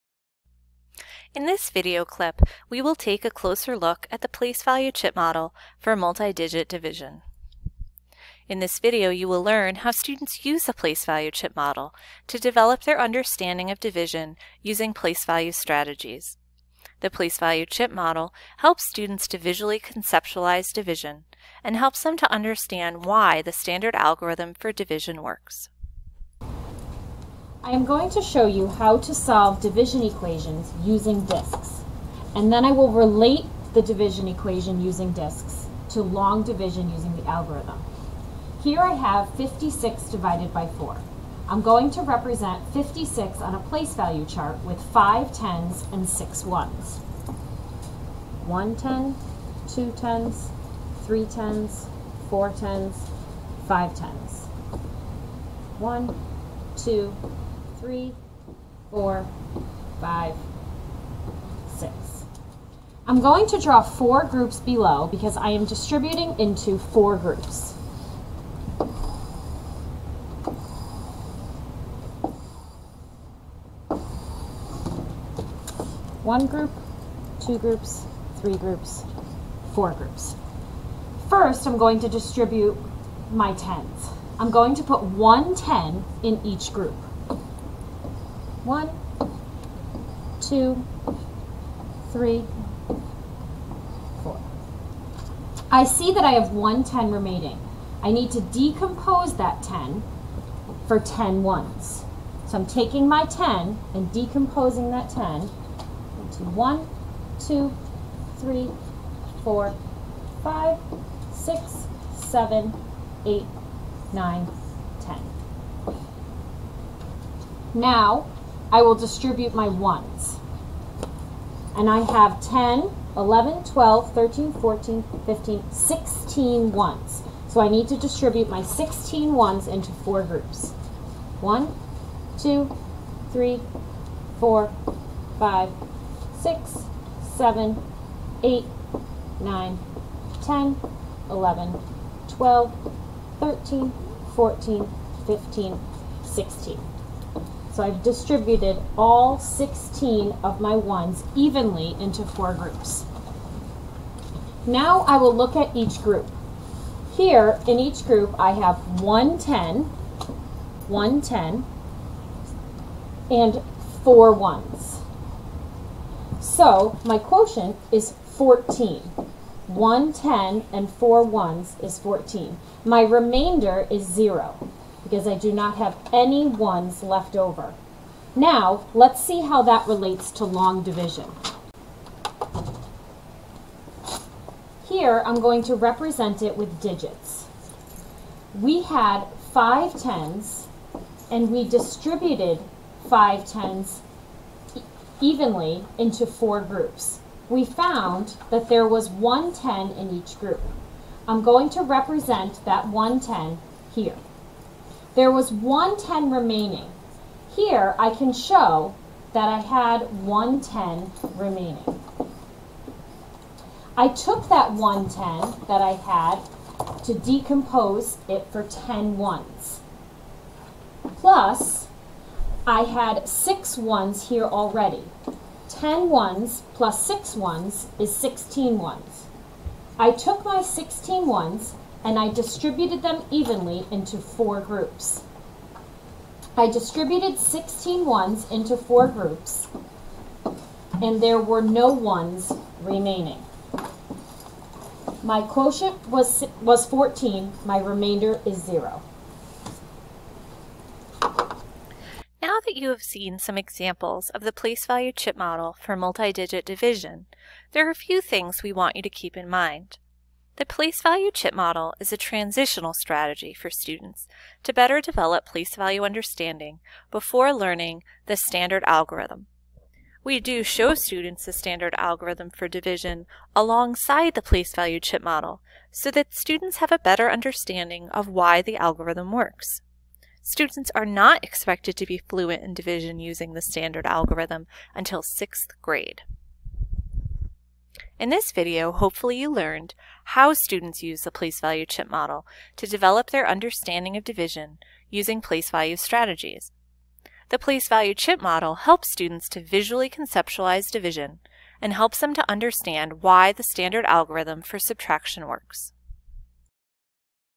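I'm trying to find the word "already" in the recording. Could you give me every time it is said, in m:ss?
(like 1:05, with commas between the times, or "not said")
3:44.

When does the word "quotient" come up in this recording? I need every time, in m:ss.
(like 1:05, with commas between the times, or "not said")
2:47, 4:05.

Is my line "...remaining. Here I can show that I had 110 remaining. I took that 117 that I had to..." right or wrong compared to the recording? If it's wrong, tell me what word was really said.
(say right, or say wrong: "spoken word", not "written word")
wrong: "110", not "117".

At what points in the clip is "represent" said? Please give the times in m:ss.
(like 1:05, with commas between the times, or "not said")
0:42, 3:05, 3:21.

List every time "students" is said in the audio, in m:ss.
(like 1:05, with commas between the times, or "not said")
0:09, 0:18, 4:23, 4:30, 4:36, 4:40, 4:50, 4:59.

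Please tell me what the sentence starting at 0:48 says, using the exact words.
1 ten, 2 tens, 3 tens, 4 tens, 5 tens.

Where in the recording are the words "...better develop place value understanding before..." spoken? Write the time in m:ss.
4:24.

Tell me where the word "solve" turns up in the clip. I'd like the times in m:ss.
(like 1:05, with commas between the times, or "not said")
0:29.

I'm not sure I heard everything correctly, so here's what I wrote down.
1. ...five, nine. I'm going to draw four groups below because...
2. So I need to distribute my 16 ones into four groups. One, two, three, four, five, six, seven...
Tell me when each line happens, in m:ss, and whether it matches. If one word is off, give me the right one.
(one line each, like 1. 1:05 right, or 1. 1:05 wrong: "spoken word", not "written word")
1. 0:59 wrong: "six", not "nine"
2. 2:07 right.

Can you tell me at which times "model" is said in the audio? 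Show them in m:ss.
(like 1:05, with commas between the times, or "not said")
0:05, 0:11, 0:17, 4:15, 4:21, 4:35, 4:52, 4:58.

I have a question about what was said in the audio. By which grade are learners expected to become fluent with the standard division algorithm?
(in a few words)
sixth grade.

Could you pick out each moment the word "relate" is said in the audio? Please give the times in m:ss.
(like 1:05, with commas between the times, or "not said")
0:32, 2:59.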